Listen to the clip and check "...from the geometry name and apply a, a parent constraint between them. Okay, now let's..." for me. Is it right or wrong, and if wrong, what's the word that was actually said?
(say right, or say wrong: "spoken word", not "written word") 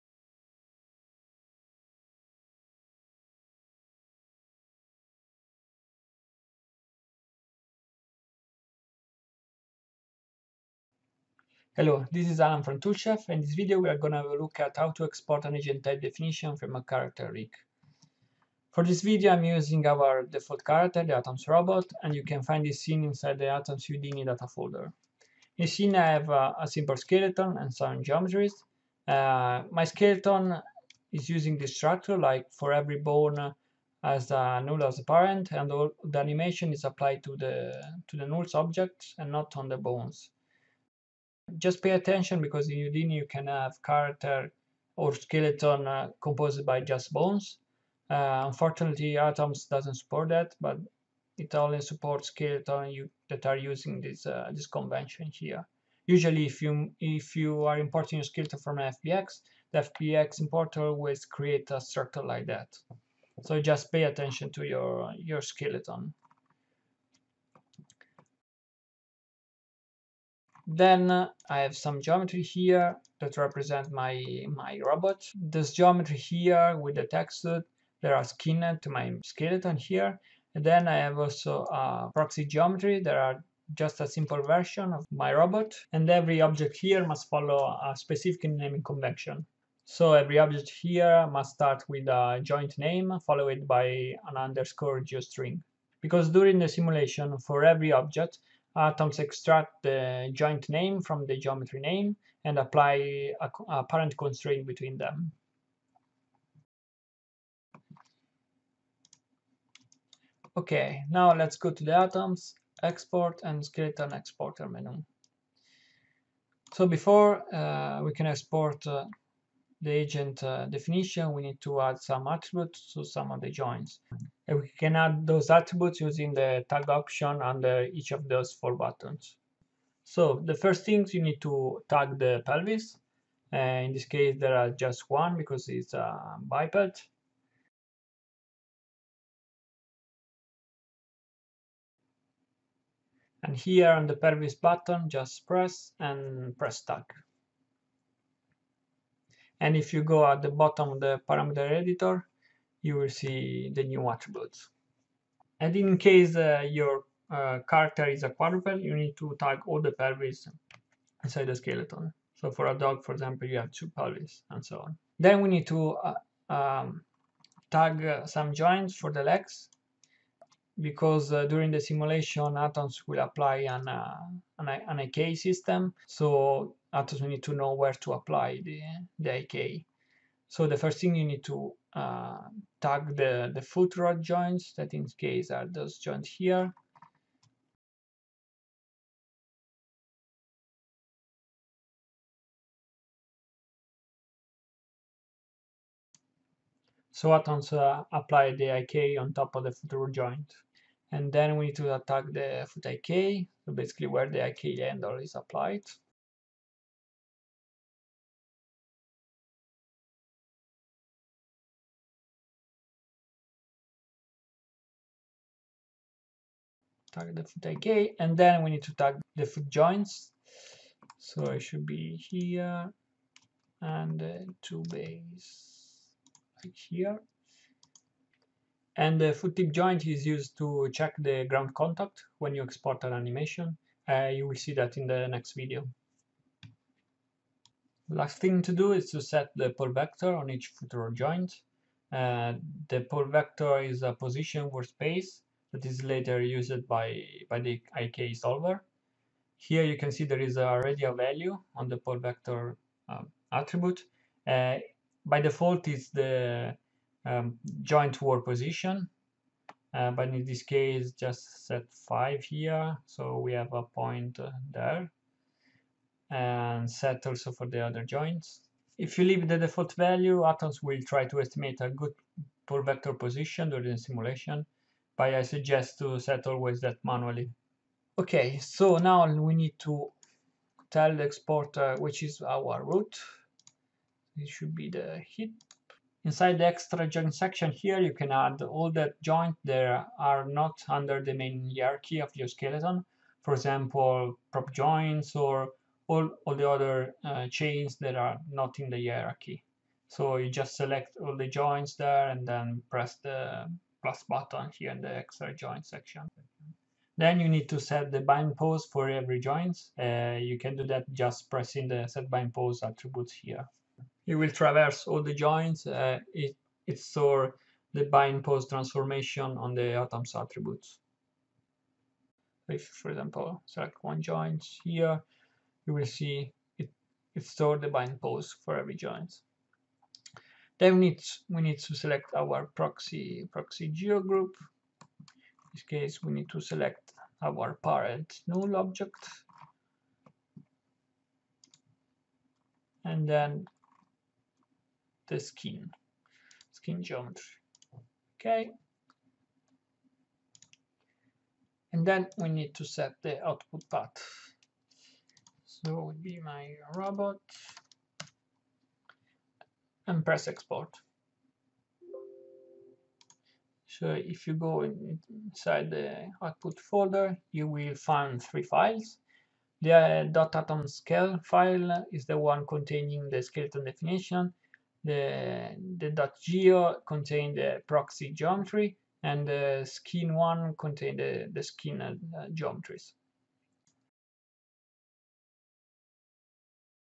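right.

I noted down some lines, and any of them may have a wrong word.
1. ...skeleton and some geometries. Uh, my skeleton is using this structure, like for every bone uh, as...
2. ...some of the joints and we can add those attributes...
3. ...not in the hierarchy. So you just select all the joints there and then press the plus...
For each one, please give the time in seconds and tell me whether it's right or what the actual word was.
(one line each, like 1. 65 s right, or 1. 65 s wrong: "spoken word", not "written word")
1. 26 s right
2. 123 s right
3. 298 s right.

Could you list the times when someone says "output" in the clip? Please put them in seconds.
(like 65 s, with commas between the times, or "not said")
353 s, 366 s.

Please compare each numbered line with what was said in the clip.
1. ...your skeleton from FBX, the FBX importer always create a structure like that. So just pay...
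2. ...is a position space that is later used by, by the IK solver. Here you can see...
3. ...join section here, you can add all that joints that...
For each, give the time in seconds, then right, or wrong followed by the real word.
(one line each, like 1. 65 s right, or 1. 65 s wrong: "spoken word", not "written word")
1. 58 s right
2. 243 s right
3. 287 s right.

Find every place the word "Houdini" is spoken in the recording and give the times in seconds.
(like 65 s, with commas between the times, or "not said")
23 s, 42 s.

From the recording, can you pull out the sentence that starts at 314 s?
You will traverse all the joins.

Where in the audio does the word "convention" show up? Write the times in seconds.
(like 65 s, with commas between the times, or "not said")
54 s, 88 s.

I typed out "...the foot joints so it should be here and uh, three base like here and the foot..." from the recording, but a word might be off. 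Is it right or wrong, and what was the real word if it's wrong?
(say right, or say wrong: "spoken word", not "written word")
wrong: "two", not "three".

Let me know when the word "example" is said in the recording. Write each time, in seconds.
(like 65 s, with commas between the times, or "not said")
163 s, 293 s, 323 s.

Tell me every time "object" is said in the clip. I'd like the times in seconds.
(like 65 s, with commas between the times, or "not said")
38 s, 86 s, 90 s, 97 s, 338 s.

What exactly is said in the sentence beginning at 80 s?
And then I have also a proxy geometry.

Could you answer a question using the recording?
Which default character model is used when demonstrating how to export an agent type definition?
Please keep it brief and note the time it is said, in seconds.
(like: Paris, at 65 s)
Atoms robot, at 21 s.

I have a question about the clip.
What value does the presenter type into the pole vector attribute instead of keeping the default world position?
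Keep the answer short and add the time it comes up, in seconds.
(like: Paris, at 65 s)
5, at 262 s.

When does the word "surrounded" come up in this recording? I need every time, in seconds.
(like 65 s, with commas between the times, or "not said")
not said.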